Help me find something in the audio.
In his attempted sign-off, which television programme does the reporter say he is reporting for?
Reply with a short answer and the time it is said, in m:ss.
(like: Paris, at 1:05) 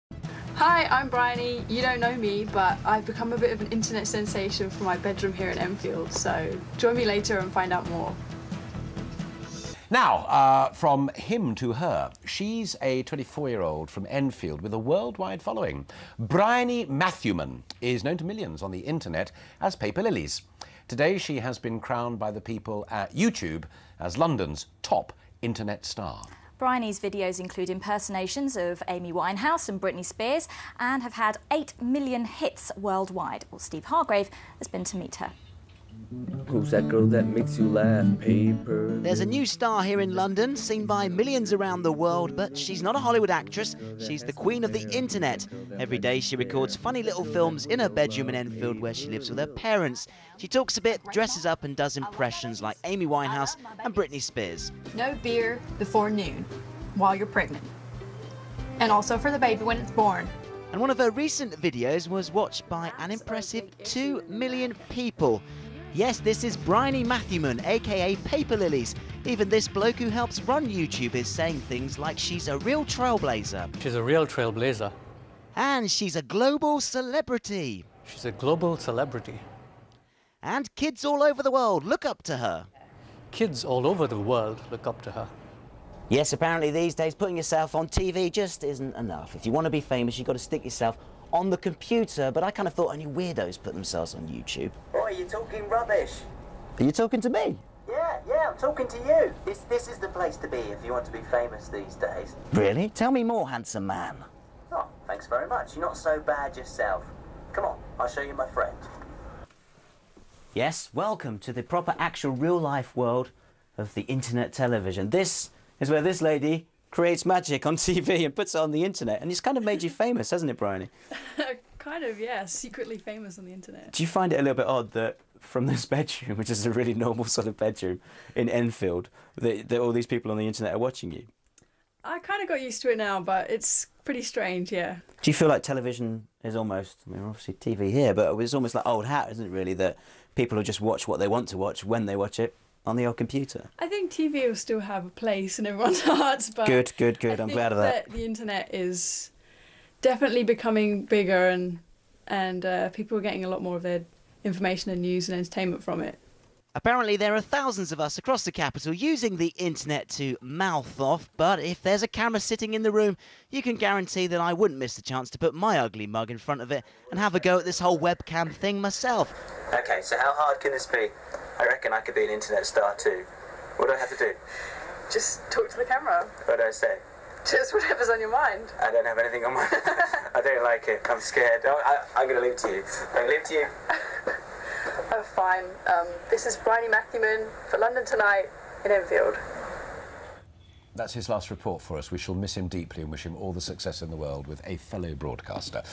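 London Tonight, at 3:07.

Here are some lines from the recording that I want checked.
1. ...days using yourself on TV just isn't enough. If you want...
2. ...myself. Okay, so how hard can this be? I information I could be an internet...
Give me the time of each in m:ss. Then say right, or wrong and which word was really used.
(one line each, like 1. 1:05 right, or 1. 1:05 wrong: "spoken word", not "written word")
1. 1:26 wrong: "putting", not "using"
2. 2:48 wrong: "reckon", not "information".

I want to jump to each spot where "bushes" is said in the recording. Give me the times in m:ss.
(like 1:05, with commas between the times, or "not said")
not said.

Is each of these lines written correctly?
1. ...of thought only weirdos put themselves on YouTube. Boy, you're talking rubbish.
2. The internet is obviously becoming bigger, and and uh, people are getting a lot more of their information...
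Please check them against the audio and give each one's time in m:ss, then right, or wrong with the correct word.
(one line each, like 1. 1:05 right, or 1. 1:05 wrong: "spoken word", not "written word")
1. 1:32 right
2. 2:28 wrong: "definitely", not "obviously".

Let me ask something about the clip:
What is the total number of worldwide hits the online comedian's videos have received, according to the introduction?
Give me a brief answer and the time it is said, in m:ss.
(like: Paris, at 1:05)
8 million, at 0:31.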